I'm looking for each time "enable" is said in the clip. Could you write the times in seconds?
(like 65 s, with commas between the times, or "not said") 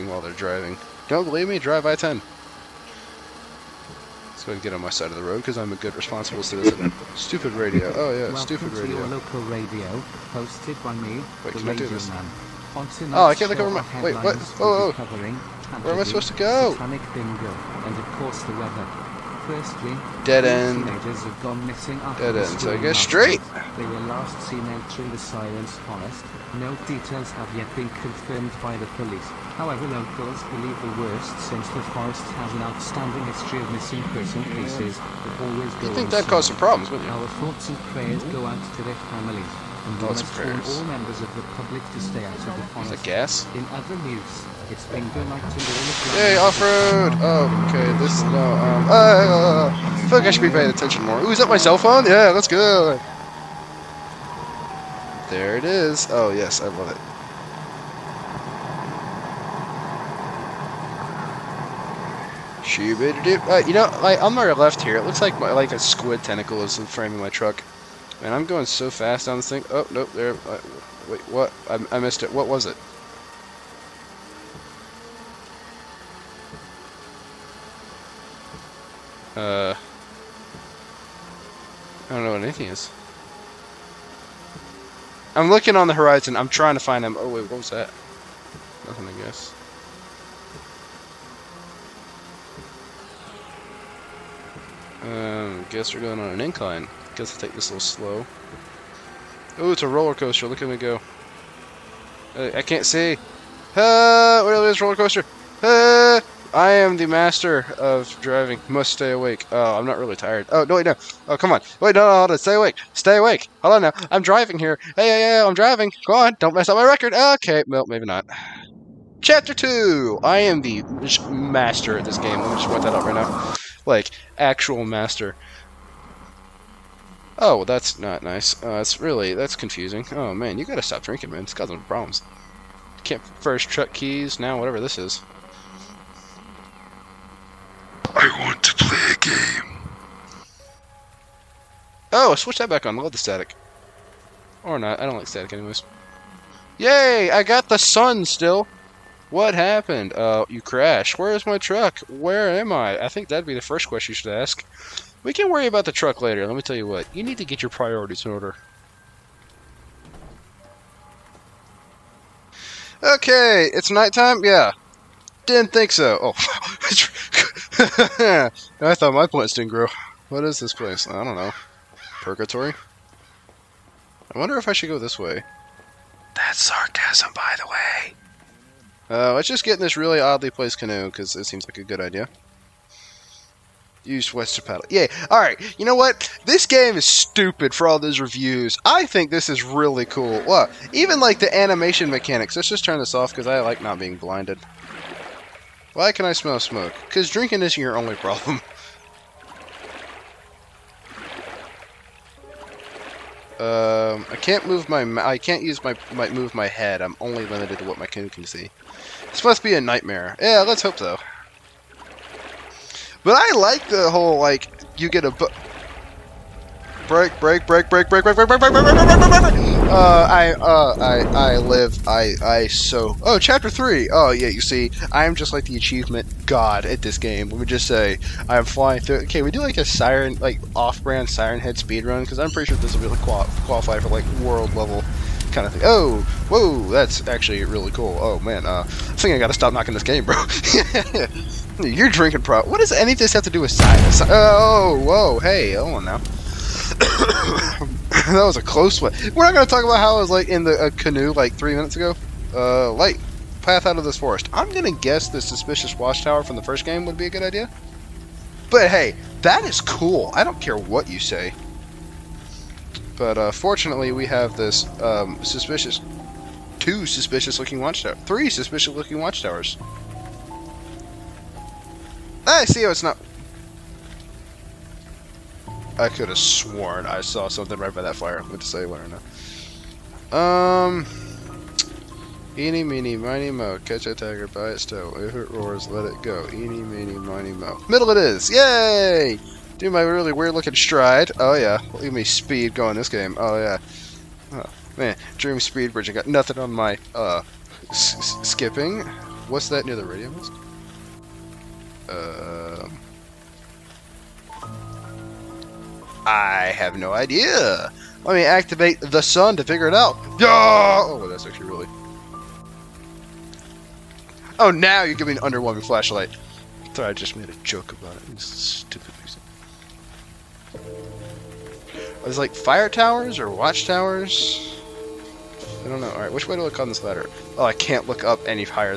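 not said.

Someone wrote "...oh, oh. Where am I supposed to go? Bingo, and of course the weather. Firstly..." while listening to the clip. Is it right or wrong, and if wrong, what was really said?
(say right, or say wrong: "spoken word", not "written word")
right.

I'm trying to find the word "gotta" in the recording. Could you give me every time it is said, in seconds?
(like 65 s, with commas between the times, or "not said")
130 s, 239 s.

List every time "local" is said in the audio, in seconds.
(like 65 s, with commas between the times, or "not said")
9 s, 29 s.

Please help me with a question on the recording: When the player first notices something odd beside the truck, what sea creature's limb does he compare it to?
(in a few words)
squid tentacle.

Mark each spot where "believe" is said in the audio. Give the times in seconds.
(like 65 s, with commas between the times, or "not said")
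1 s, 30 s.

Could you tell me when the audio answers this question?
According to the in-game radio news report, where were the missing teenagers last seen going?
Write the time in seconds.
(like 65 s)
25 s.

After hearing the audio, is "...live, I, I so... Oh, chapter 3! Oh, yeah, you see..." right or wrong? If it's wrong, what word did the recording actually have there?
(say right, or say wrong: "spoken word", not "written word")
right.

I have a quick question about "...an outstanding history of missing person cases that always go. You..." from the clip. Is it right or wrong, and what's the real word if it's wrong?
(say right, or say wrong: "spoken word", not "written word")
right.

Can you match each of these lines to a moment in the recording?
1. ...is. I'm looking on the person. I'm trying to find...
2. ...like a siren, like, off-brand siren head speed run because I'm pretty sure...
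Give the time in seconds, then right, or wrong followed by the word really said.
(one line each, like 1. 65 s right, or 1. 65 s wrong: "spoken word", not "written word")
1. 82 s wrong: "horizon", not "person"
2. 229 s right.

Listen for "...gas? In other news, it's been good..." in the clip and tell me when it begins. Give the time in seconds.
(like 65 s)
43 s.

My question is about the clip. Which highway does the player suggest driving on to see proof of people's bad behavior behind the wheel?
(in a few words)
I-10.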